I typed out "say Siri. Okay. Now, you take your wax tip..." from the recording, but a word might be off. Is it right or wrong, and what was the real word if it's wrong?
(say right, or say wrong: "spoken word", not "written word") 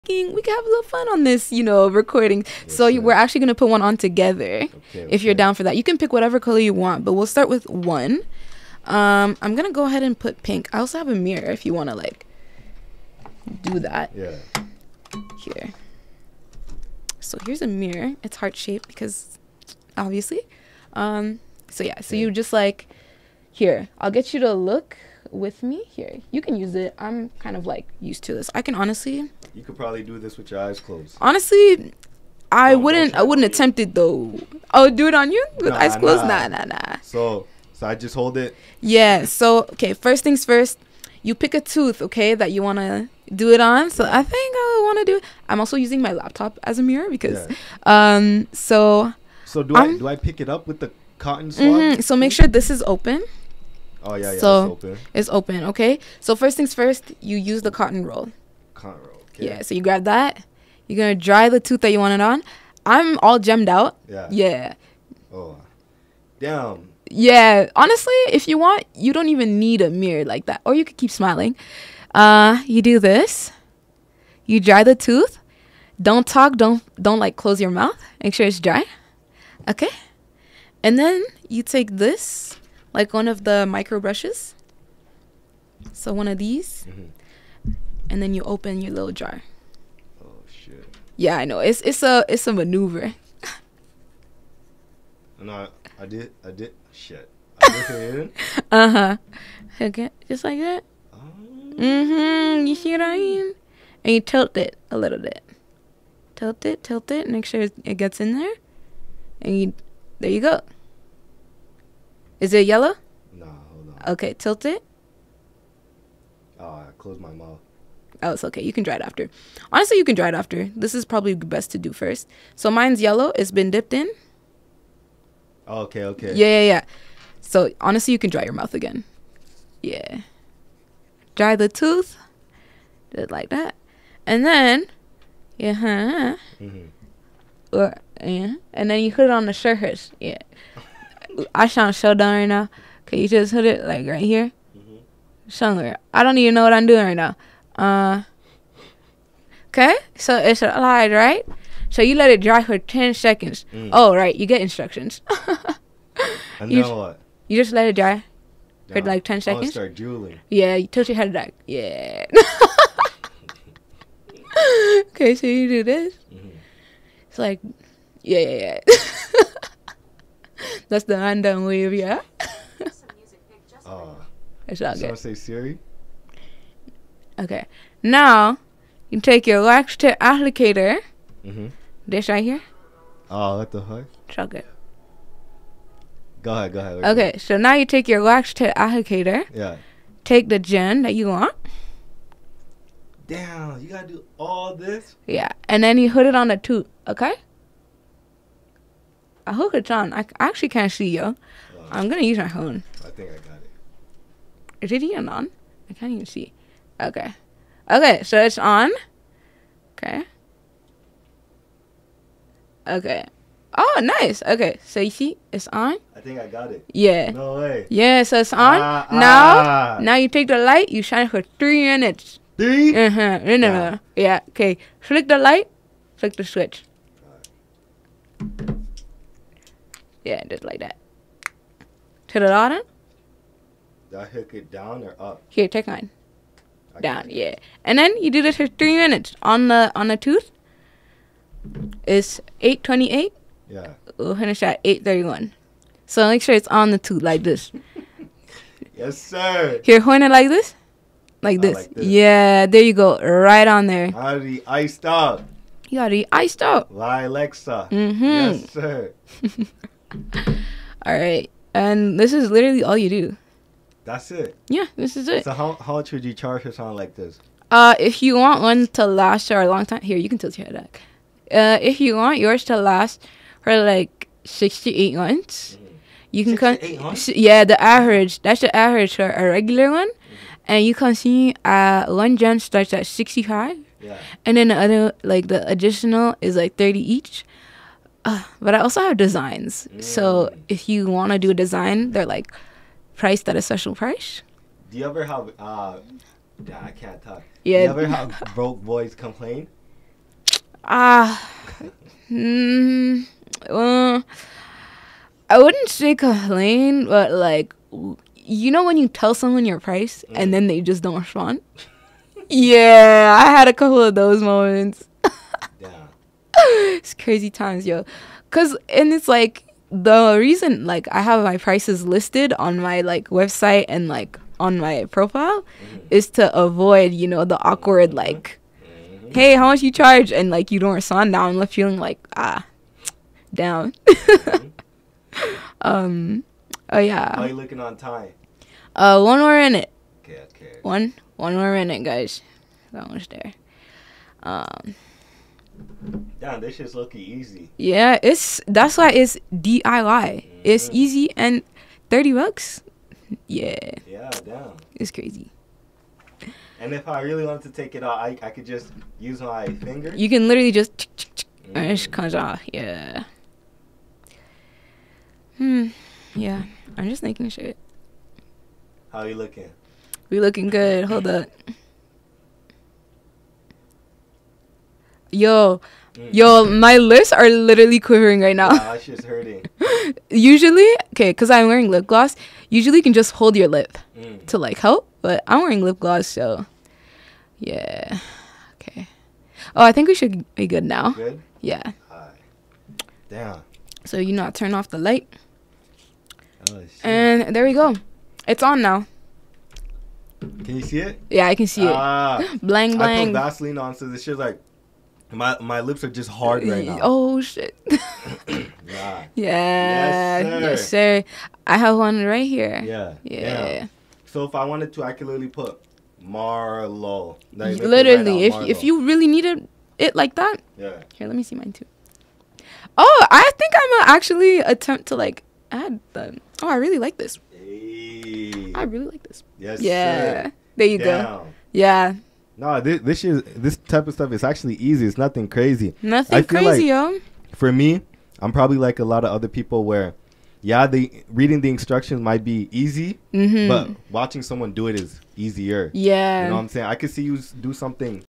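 right.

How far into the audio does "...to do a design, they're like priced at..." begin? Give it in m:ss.
4:51.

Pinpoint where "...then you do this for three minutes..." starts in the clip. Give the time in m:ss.
3:57.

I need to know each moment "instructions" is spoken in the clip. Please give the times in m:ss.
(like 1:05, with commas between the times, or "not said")
2:34, 7:21.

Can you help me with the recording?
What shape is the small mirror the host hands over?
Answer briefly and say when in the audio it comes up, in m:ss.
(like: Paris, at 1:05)
Heart shaped, at 0:18.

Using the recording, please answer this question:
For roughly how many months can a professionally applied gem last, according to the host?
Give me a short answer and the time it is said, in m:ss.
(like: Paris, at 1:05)
6 to 8 months, at 4:34.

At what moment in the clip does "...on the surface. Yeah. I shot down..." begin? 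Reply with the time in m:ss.
2:19.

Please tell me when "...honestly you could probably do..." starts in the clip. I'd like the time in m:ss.
0:28.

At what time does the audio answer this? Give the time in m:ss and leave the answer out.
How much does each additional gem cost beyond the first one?
4:46.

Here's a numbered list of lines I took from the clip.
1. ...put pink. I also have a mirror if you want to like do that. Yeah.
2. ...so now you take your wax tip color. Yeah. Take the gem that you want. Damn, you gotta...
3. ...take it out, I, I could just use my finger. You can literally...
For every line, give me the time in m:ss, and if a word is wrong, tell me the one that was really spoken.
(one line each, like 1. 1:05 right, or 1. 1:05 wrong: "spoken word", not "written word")
1. 0:10 right
2. 3:07 wrong: "applicator", not "color"
3. 5:57 right.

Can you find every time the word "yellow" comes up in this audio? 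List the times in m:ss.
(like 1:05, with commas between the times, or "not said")
1:52, 2:02.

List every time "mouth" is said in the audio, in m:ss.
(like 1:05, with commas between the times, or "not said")
1:17, 1:57, 2:08.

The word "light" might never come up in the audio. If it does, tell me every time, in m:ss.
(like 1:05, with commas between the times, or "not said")
3:40, 3:45, 6:34.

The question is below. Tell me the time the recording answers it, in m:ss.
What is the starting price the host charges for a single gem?
4:43.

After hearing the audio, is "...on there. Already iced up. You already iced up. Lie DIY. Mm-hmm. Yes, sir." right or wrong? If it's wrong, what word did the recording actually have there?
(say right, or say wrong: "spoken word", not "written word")
wrong: "Alexa", not "DIY".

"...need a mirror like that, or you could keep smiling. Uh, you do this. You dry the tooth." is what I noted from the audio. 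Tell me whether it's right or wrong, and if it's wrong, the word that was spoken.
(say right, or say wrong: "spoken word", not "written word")
right.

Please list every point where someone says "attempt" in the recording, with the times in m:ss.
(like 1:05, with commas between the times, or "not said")
0:33, 7:04.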